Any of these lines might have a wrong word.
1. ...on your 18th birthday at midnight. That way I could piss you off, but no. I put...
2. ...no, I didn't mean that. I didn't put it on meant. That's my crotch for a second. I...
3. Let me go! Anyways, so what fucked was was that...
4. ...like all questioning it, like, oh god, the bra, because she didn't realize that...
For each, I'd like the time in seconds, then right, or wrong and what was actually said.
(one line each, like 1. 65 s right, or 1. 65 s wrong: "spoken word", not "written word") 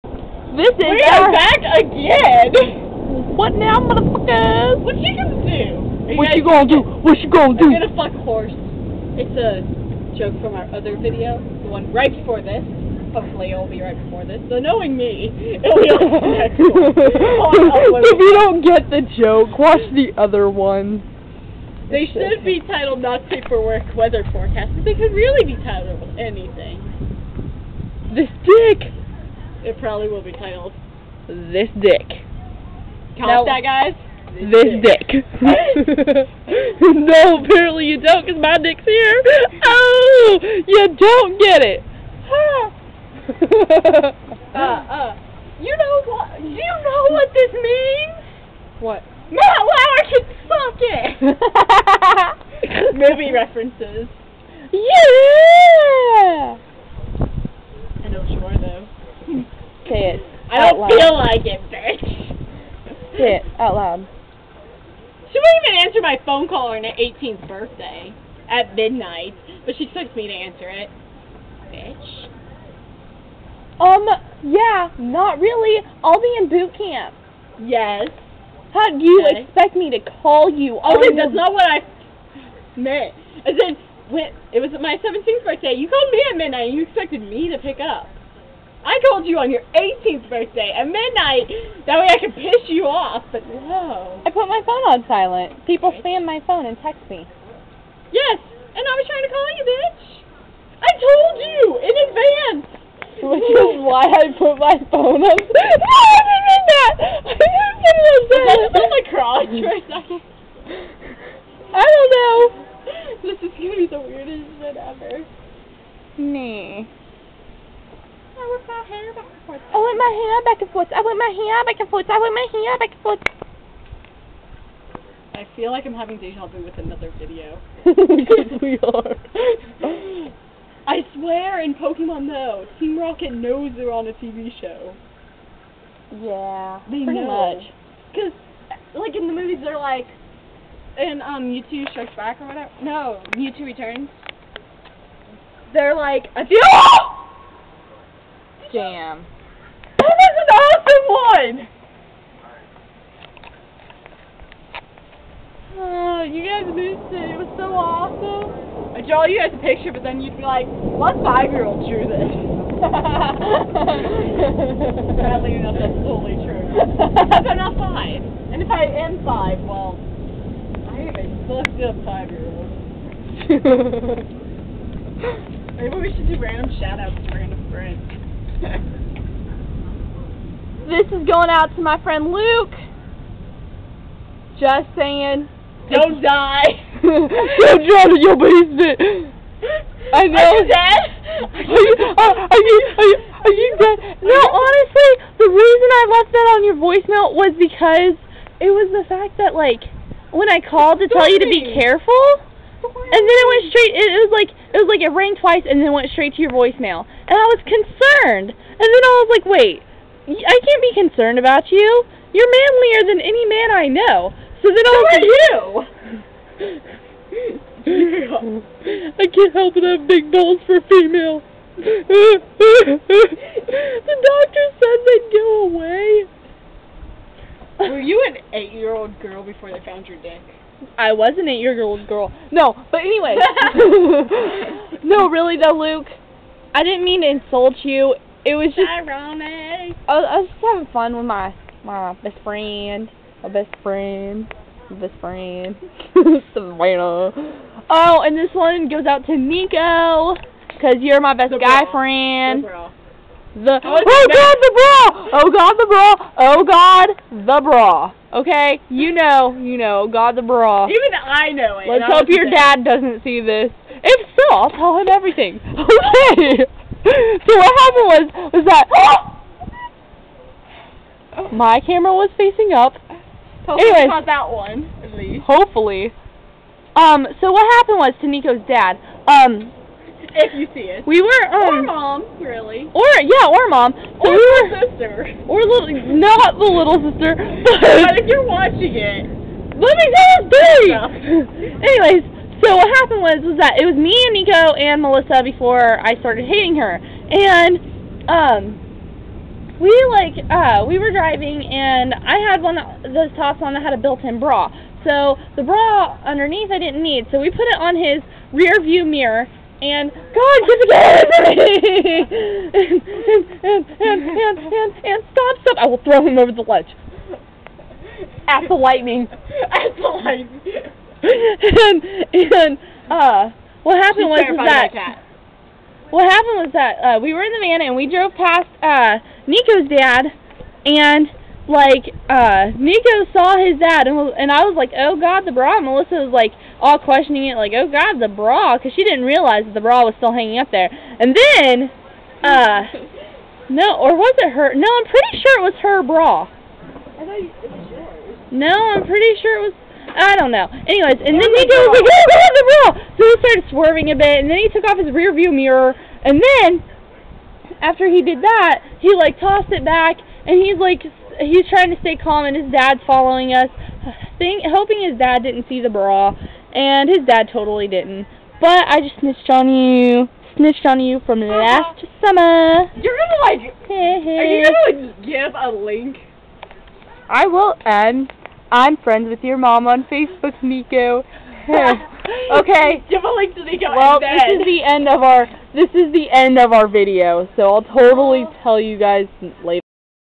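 1. 89 s right
2. 105 s wrong: "silent", not "meant"
3. 289 s wrong: "happened", not "fucked"
4. 336 s right.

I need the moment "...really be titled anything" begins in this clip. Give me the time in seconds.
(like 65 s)
25 s.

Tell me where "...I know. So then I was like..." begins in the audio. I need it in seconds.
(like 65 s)
213 s.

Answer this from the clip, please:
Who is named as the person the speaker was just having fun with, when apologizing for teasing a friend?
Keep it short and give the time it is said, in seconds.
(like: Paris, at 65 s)
Savannah, at 246 s.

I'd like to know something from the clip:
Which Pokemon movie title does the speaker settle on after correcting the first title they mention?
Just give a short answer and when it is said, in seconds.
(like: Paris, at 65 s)
Mewtwo Returns, at 143 s.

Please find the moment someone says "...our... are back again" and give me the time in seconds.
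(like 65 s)
1 s.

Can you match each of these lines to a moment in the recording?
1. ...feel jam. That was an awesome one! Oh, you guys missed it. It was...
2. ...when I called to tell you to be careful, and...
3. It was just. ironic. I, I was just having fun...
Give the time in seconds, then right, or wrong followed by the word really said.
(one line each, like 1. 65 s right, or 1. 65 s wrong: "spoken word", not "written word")
1. 146 s right
2. 200 s right
3. 238 s right.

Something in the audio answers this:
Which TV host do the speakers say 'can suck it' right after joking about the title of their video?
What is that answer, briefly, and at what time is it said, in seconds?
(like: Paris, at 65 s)
Matt Lauer, at 49 s.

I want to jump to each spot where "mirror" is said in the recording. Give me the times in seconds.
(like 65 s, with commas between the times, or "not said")
309 s, 355 s.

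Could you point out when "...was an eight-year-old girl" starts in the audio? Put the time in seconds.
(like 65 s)
231 s.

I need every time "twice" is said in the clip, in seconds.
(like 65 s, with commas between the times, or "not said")
205 s.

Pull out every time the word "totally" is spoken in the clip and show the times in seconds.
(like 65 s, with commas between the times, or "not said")
166 s, 367 s, 387 s.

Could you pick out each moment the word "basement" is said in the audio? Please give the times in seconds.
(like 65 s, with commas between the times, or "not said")
188 s.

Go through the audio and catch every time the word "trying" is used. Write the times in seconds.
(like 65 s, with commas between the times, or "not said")
99 s, 361 s.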